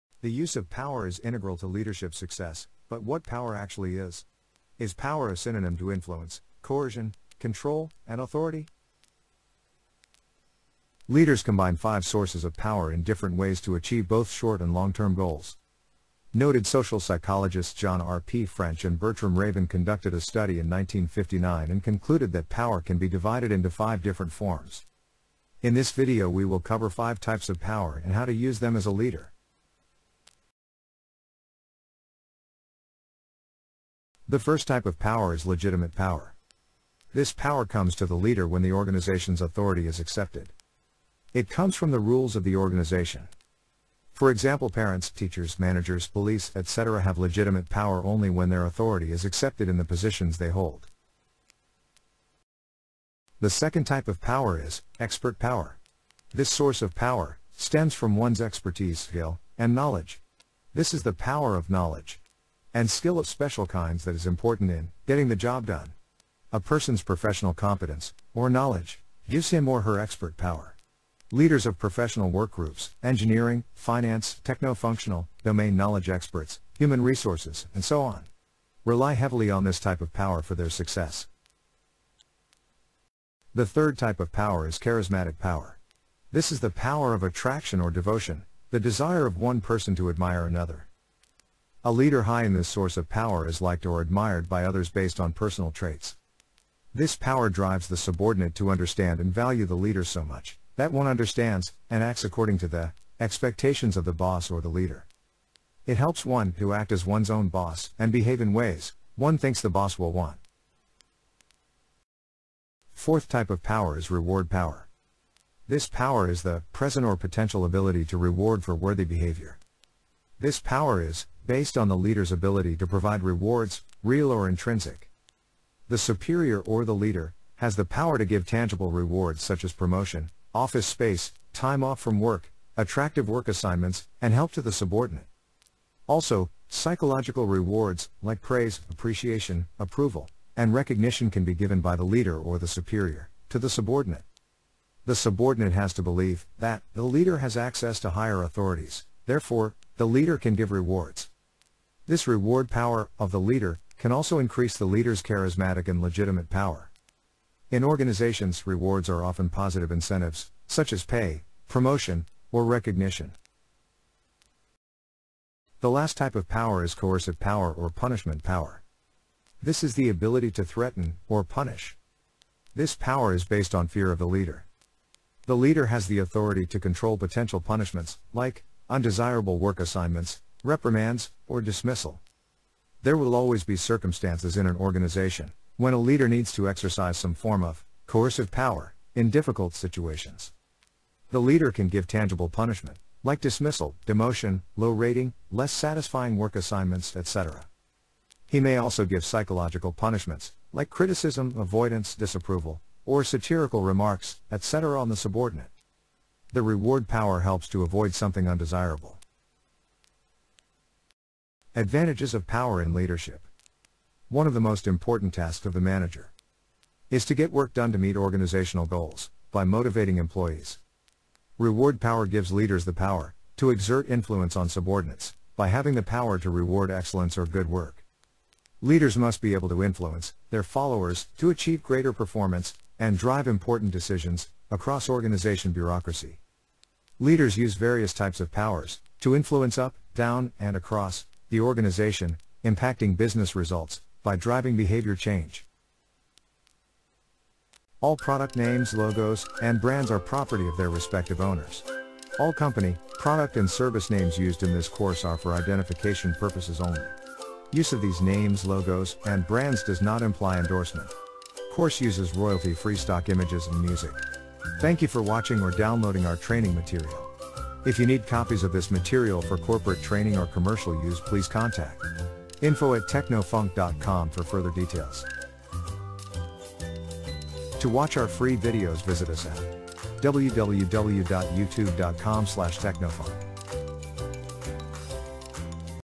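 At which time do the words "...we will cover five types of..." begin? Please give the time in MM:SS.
00:26.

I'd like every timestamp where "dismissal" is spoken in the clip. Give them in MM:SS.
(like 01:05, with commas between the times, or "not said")
03:01, 03:13.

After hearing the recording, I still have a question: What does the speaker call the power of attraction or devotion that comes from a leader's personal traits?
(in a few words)
Charismatic power.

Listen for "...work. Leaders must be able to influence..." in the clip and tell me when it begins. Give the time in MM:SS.
03:47.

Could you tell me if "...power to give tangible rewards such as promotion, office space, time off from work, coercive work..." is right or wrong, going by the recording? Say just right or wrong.
wrong.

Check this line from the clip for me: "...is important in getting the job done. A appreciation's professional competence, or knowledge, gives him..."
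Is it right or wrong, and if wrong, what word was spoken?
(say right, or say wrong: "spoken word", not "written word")
wrong: "person", not "appreciation".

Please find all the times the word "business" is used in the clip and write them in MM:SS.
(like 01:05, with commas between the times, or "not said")
04:03.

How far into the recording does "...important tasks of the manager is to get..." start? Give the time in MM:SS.
03:34.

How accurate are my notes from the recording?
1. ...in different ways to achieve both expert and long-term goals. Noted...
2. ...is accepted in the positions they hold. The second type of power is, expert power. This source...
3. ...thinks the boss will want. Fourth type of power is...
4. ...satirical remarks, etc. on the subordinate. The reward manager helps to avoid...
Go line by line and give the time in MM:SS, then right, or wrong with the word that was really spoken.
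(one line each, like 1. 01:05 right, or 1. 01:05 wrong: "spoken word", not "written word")
1. 00:12 wrong: "short", not "expert"
2. 00:49 right
3. 01:49 right
4. 03:23 wrong: "power", not "manager".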